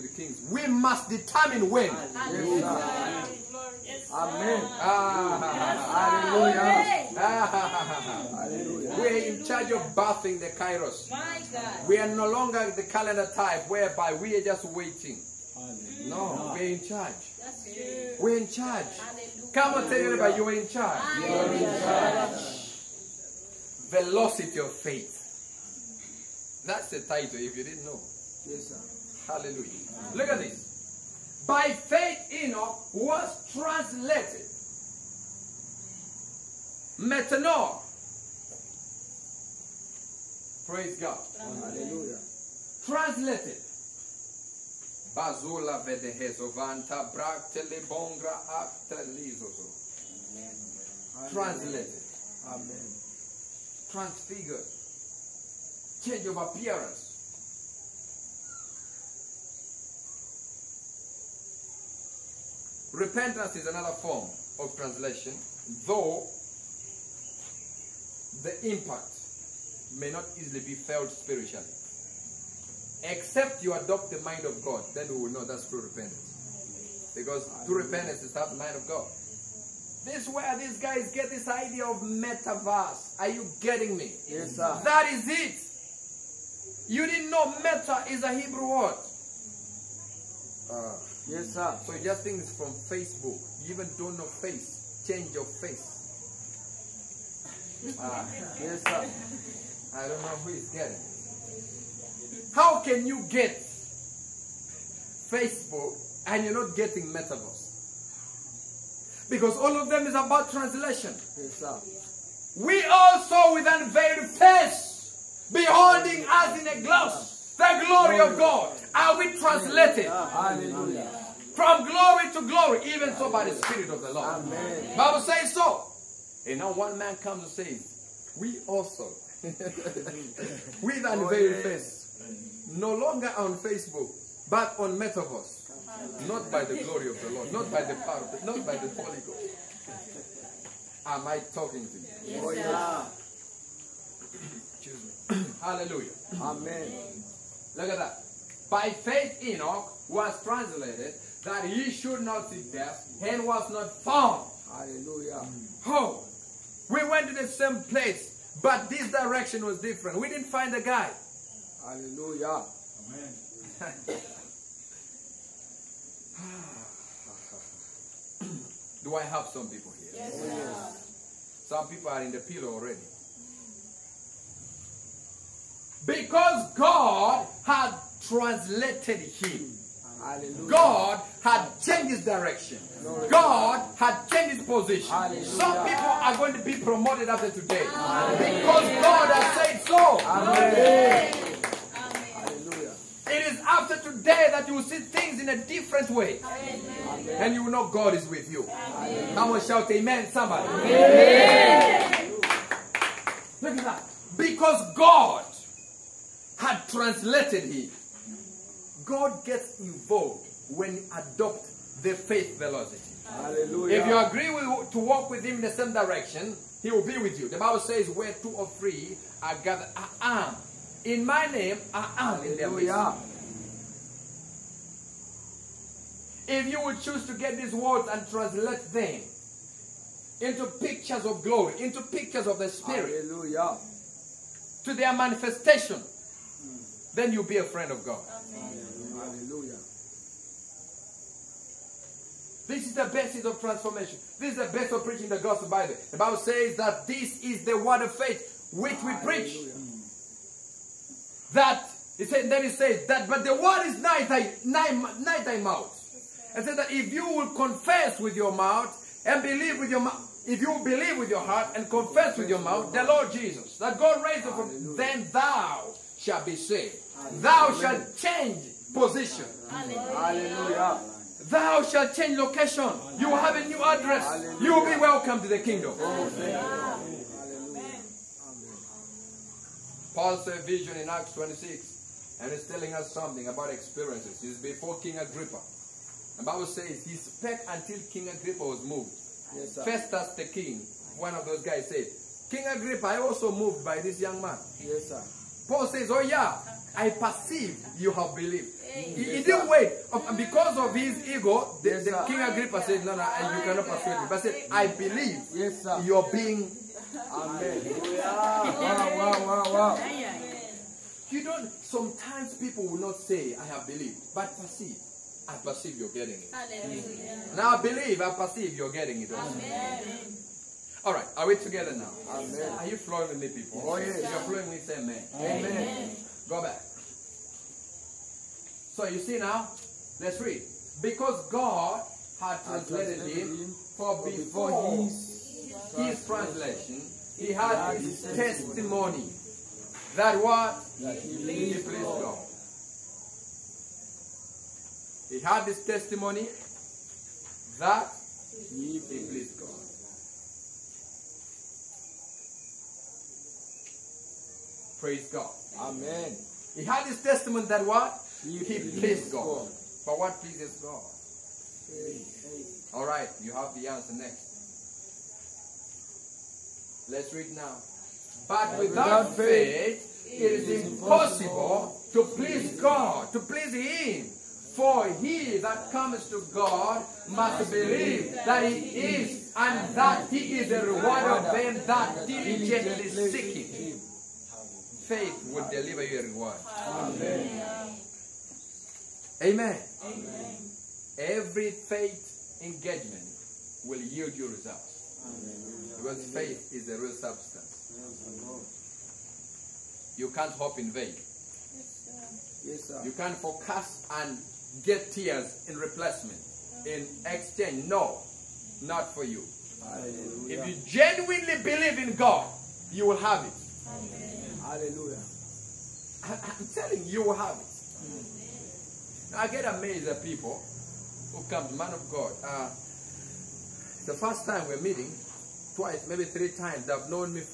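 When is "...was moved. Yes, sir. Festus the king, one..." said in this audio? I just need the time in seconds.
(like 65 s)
288 s.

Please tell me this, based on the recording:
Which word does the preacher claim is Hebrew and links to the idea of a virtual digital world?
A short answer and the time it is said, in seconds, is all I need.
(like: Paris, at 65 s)
meta, at 87 s.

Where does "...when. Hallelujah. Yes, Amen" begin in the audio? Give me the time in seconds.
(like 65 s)
1 s.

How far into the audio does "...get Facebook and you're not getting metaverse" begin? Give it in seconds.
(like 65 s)
103 s.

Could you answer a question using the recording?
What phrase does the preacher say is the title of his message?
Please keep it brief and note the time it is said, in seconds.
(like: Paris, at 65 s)
Velocity of faith, at 23 s.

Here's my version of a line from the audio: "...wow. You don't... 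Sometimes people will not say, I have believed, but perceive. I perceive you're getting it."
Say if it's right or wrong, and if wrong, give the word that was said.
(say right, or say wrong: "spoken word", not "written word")
right.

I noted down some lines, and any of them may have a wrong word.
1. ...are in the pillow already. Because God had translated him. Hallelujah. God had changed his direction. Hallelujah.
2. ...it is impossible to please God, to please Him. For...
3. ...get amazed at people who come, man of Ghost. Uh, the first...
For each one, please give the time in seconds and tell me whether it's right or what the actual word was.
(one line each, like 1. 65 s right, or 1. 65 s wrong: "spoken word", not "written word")
1. 172 s right
2. 370 s right
3. 419 s wrong: "God", not "Ghost".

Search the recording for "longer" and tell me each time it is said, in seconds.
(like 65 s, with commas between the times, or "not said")
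12 s, 132 s.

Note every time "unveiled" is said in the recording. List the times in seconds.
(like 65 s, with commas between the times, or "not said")
113 s, 131 s.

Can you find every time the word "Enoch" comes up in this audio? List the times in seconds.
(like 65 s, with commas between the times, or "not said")
32 s, 149 s.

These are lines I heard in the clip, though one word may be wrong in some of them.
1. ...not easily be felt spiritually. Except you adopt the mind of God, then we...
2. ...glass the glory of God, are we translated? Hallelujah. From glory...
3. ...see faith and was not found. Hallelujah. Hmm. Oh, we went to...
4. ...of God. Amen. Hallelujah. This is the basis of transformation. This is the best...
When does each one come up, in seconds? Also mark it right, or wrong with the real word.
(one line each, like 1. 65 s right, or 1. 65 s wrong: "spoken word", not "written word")
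1. 70 s right
2. 116 s right
3. 152 s wrong: "death", not "faith"
4. 237 s right.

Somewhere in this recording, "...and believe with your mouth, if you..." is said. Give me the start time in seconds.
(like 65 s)
259 s.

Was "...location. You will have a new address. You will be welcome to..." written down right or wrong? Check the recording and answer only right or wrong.
right.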